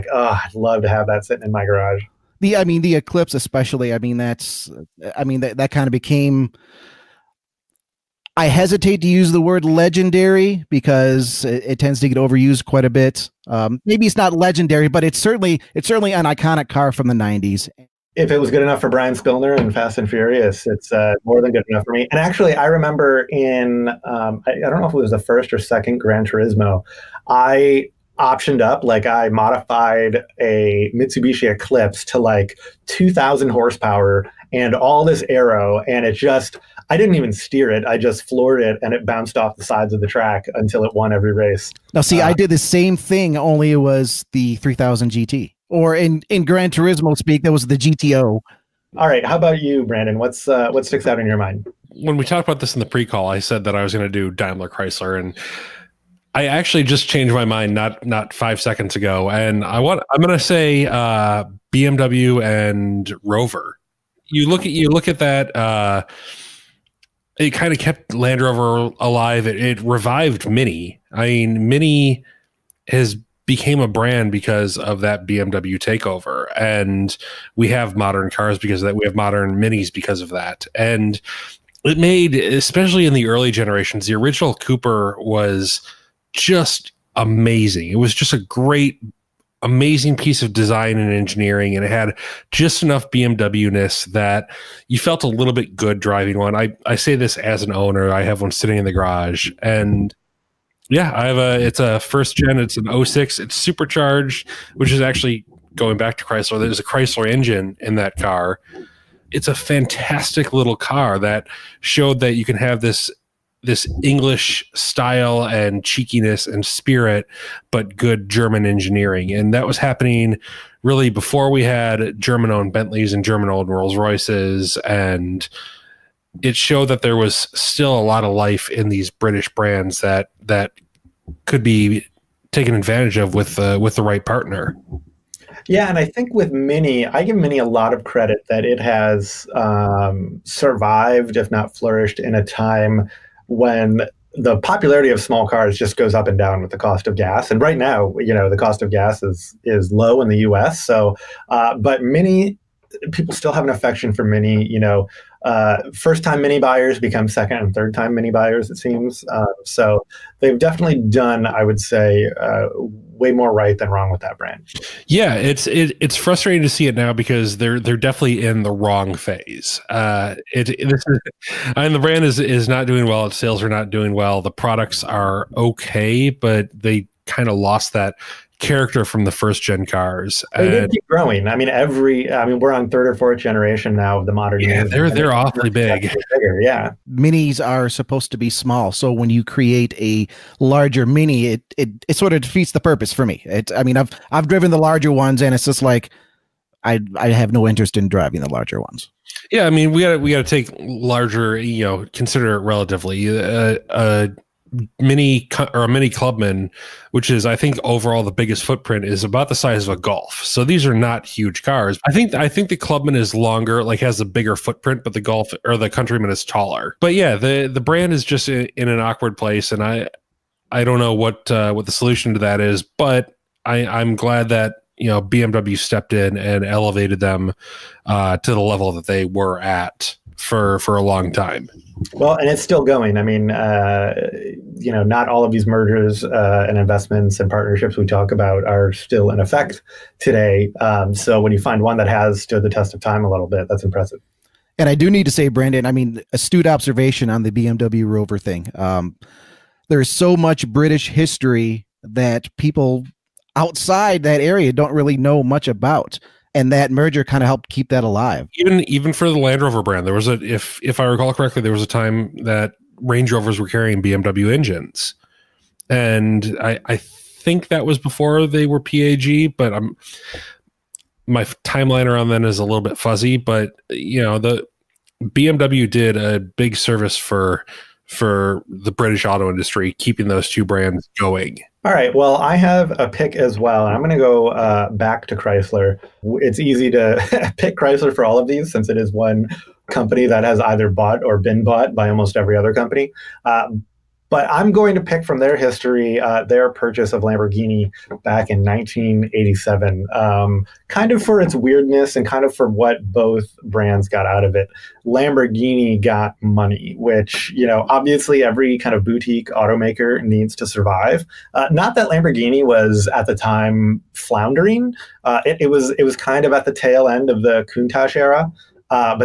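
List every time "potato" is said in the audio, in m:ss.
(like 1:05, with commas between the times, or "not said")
not said.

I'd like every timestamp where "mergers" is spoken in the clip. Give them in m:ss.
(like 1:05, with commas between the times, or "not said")
3:55, 4:16.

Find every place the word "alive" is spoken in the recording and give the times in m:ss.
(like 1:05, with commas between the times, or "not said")
1:08, 4:18.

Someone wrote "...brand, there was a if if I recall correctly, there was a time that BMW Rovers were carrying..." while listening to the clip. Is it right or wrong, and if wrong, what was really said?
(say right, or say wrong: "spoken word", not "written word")
wrong: "Range", not "BMW".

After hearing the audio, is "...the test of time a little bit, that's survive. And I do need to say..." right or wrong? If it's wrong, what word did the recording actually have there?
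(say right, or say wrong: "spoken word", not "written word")
wrong: "impressive", not "survive".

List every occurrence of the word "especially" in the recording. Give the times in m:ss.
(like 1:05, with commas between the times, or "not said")
0:03, 1:22.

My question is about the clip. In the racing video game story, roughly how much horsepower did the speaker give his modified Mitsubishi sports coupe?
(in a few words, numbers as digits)
2000.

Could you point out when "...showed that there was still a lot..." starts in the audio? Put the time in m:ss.
2:06.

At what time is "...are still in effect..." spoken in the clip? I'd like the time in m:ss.
3:58.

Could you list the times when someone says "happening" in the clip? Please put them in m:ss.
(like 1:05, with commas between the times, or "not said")
1:59.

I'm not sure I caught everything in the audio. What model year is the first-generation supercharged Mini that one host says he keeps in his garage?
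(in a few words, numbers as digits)
2006.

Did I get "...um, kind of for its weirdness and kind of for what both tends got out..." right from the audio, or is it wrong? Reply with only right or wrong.
wrong.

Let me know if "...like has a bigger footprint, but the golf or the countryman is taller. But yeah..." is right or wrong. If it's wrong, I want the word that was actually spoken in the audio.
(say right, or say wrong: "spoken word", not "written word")
right.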